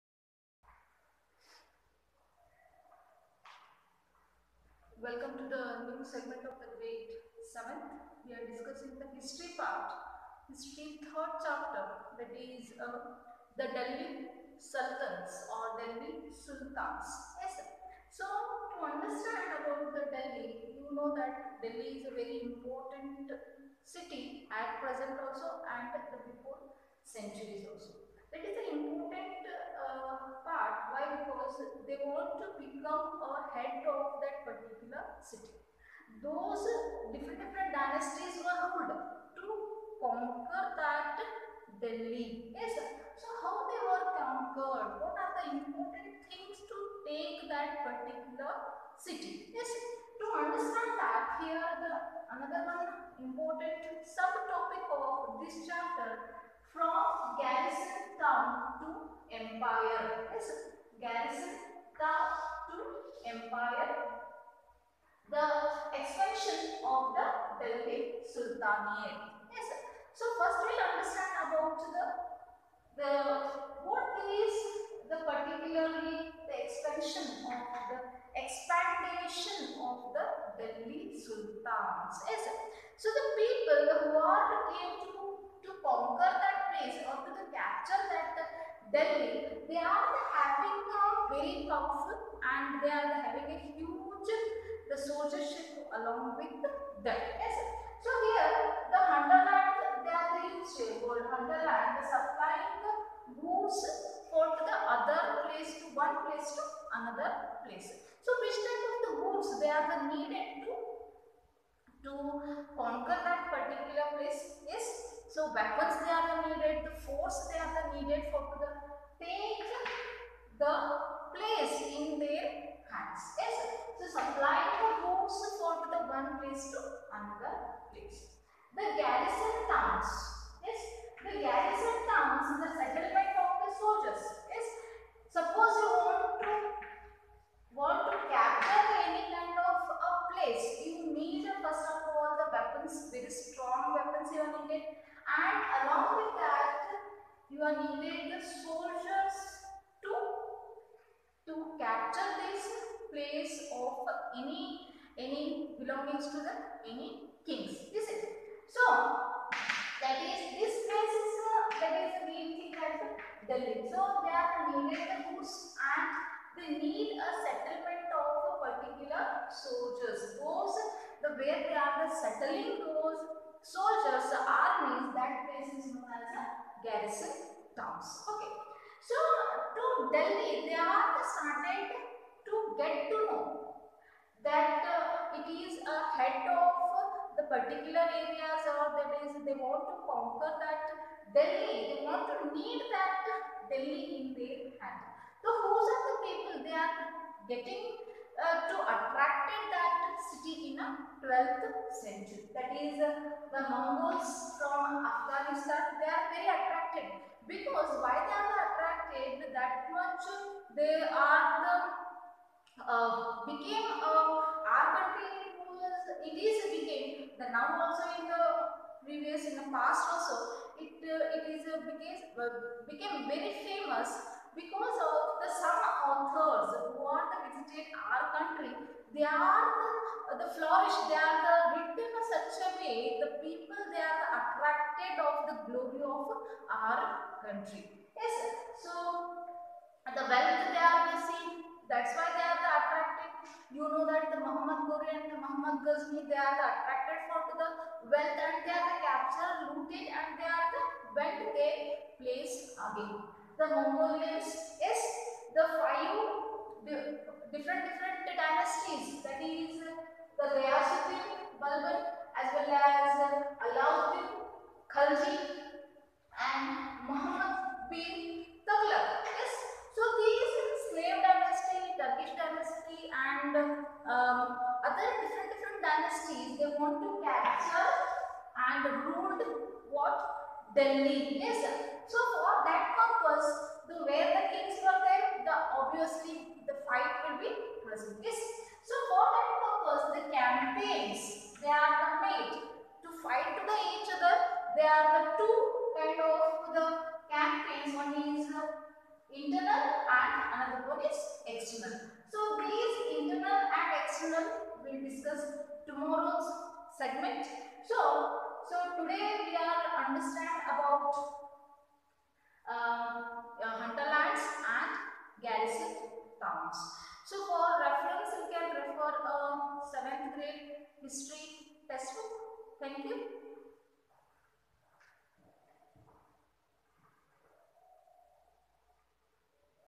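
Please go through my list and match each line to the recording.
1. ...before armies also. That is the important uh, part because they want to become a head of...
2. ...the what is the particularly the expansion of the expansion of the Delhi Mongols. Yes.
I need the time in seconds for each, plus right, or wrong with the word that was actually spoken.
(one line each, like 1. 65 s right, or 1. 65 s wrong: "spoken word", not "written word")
1. 26 s wrong: "centuries", not "armies"
2. 72 s wrong: "Sultans", not "Mongols".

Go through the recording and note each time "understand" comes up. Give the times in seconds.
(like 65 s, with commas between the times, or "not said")
18 s, 50 s, 70 s, 310 s.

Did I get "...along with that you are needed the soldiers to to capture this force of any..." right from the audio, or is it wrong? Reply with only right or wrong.
wrong.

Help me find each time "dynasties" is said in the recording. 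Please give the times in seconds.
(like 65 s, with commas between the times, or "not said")
37 s, 258 s, 275 s.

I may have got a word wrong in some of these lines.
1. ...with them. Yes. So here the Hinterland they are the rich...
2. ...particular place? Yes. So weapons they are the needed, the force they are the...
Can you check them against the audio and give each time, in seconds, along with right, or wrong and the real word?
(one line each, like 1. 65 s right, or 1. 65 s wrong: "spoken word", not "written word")
1. 96 s right
2. 113 s right.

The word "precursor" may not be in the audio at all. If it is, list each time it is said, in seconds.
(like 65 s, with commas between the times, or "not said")
not said.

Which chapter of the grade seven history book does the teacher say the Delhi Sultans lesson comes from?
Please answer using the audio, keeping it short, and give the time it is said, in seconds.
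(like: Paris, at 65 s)
3rd, at 11 s.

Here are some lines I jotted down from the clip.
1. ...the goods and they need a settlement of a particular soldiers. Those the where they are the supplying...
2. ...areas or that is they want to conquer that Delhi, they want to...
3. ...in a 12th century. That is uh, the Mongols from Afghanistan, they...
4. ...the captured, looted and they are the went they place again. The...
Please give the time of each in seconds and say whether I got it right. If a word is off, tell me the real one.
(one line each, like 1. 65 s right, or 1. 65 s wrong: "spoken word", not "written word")
1. 165 s wrong: "settling", not "supplying"
2. 188 s right
3. 200 s right
4. 248 s right.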